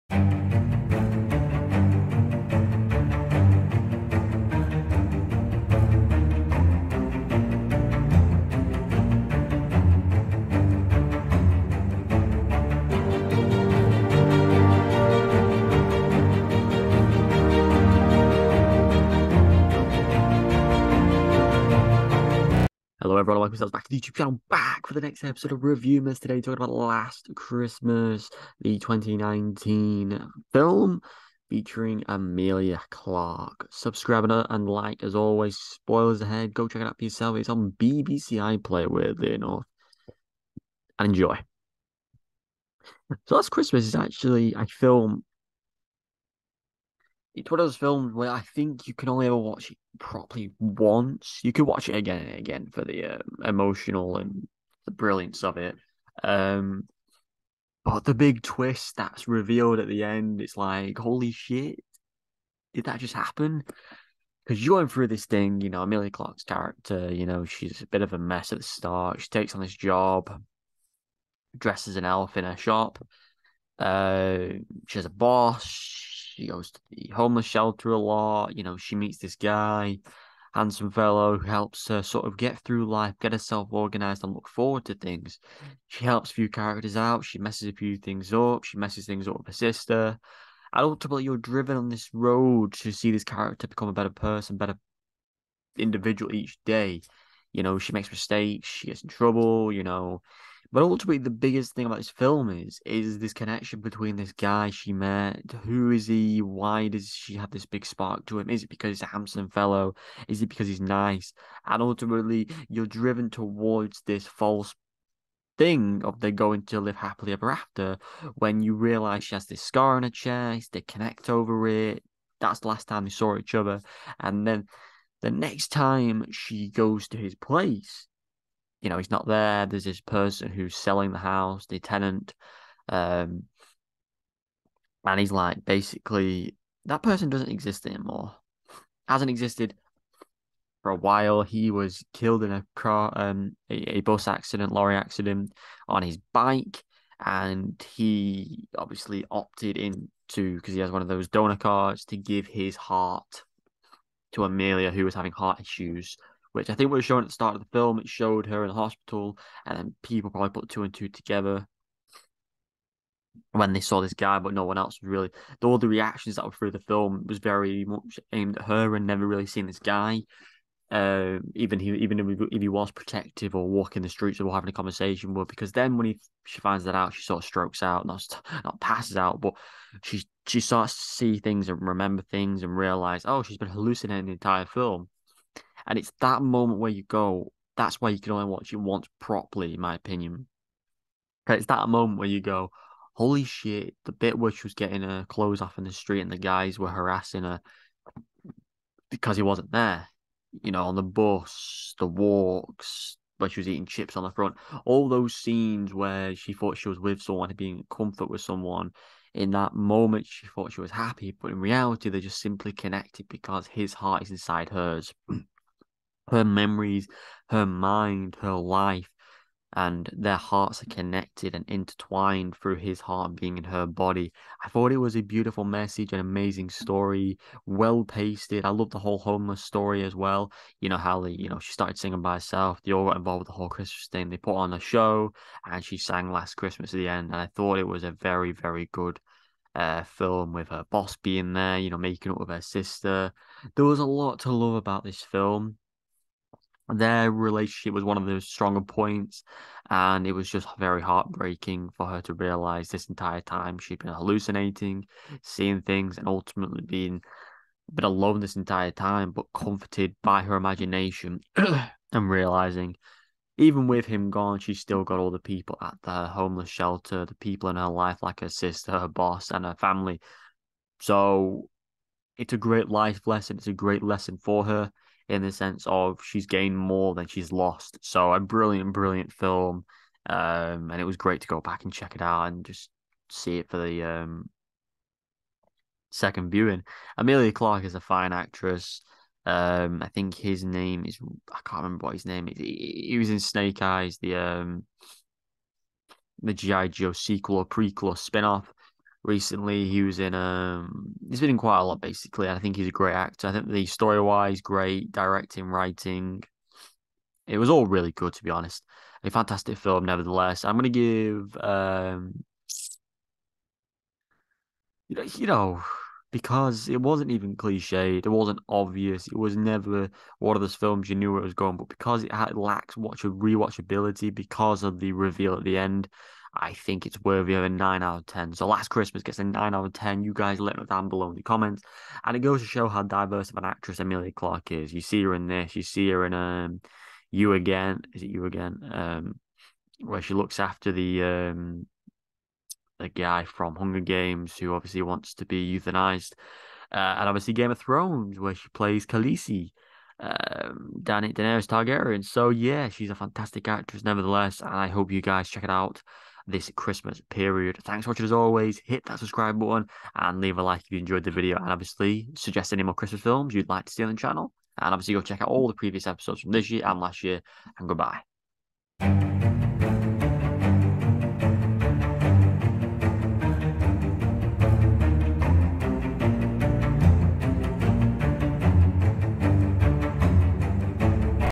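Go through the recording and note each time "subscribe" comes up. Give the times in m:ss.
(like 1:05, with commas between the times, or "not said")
0:33, 5:59.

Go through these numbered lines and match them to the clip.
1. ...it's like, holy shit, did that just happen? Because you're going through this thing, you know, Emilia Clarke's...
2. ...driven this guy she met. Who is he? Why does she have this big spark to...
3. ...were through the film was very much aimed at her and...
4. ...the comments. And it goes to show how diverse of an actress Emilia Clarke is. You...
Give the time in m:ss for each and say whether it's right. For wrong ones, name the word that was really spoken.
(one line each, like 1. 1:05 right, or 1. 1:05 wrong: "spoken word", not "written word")
1. 1:00 right
2. 1:43 wrong: "between", not "driven"
3. 2:46 right
4. 5:31 right.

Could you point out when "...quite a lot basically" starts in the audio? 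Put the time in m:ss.
5:01.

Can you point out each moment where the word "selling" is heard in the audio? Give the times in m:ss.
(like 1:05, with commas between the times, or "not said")
2:10.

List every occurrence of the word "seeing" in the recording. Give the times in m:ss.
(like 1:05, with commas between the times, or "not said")
4:15.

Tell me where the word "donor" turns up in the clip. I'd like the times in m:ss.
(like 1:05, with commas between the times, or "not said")
2:31.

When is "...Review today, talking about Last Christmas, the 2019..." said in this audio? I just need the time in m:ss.
0:25.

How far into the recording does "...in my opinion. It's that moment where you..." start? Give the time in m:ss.
3:09.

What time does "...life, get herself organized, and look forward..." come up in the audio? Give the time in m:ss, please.
1:22.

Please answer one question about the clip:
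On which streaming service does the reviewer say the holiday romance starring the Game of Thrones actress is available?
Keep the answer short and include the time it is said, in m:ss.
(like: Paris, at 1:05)
BBC iPlayer, at 0:37.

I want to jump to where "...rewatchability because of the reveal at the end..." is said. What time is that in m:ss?
5:23.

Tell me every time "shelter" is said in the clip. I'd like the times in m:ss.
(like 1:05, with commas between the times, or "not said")
1:17, 4:26.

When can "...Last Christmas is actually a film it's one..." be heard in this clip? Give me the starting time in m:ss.
0:43.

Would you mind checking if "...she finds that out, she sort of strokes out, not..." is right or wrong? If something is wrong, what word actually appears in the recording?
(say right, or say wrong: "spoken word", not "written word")
right.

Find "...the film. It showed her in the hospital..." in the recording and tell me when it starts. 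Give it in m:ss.
2:37.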